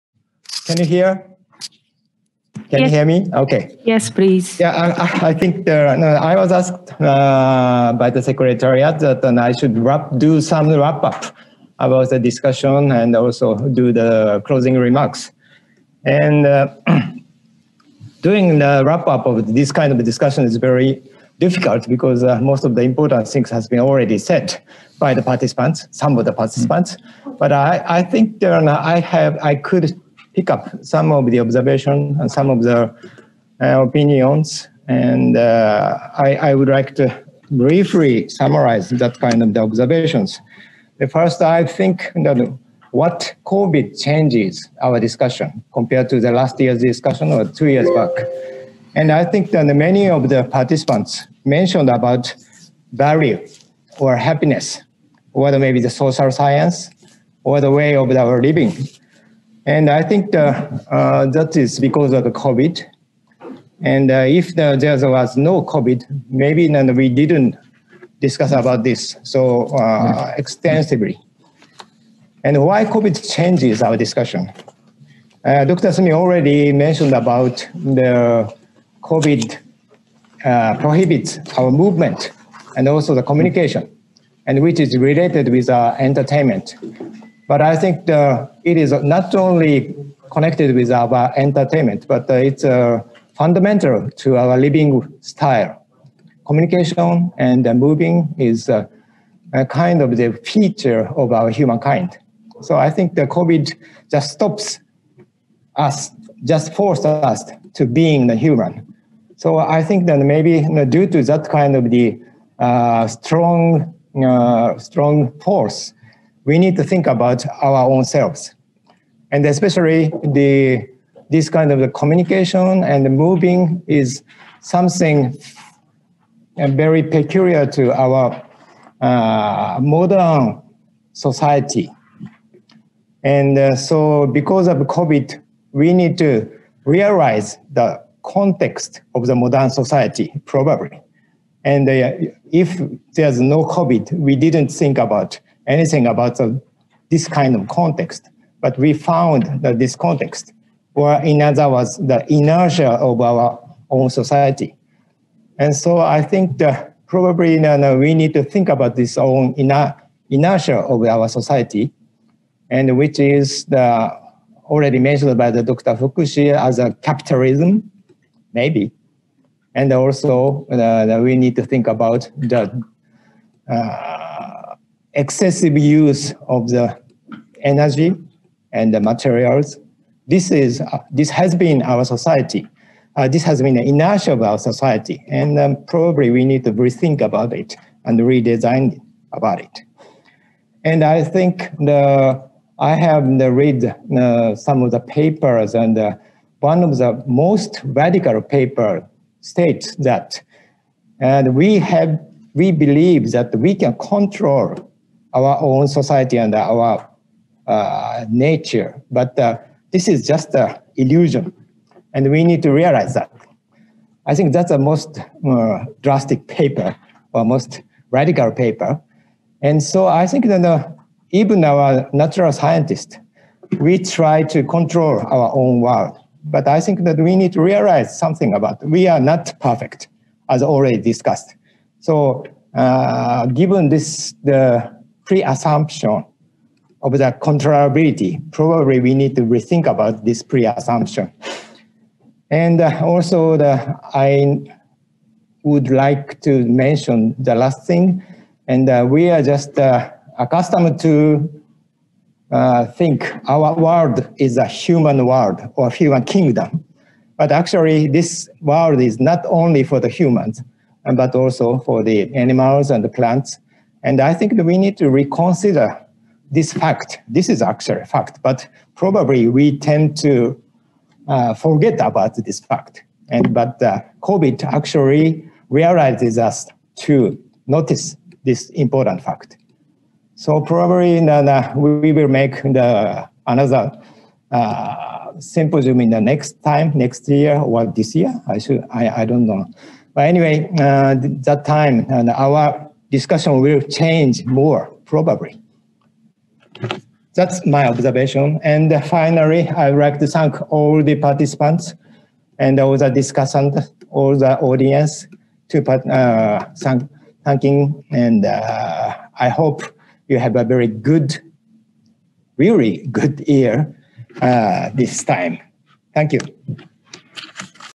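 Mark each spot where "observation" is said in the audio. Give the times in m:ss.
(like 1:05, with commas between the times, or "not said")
0:31, 0:39, 4:57.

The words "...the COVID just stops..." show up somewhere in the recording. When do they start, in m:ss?
1:43.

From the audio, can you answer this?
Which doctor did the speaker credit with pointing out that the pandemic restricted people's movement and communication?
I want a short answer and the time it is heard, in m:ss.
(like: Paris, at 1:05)
Dr. Sumi, at 1:15.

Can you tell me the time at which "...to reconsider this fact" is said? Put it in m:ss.
4:24.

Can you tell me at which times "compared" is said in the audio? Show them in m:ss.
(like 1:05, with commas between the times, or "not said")
0:45.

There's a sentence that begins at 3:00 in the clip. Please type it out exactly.
This, is, uh, this has been our society.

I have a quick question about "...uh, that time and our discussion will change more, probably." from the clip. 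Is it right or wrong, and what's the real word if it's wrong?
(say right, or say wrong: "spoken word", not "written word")
right.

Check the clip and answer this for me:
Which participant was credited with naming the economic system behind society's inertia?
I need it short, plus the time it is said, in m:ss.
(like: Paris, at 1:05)
Dr. Fukushi, at 2:45.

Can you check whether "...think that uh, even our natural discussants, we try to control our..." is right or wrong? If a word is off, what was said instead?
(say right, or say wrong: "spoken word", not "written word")
wrong: "scientists", not "discussants".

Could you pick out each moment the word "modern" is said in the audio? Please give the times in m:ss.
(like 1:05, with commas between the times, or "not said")
2:09, 2:19.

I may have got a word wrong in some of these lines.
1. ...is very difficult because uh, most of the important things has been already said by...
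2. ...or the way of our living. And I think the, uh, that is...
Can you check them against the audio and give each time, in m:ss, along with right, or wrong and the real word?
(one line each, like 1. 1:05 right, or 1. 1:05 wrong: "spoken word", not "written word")
1. 0:20 right
2. 0:57 right.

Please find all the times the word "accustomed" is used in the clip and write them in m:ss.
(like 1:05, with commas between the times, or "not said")
4:10.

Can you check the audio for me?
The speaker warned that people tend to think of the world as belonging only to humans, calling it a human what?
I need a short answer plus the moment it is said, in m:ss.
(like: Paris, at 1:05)
human kingdom, at 4:15.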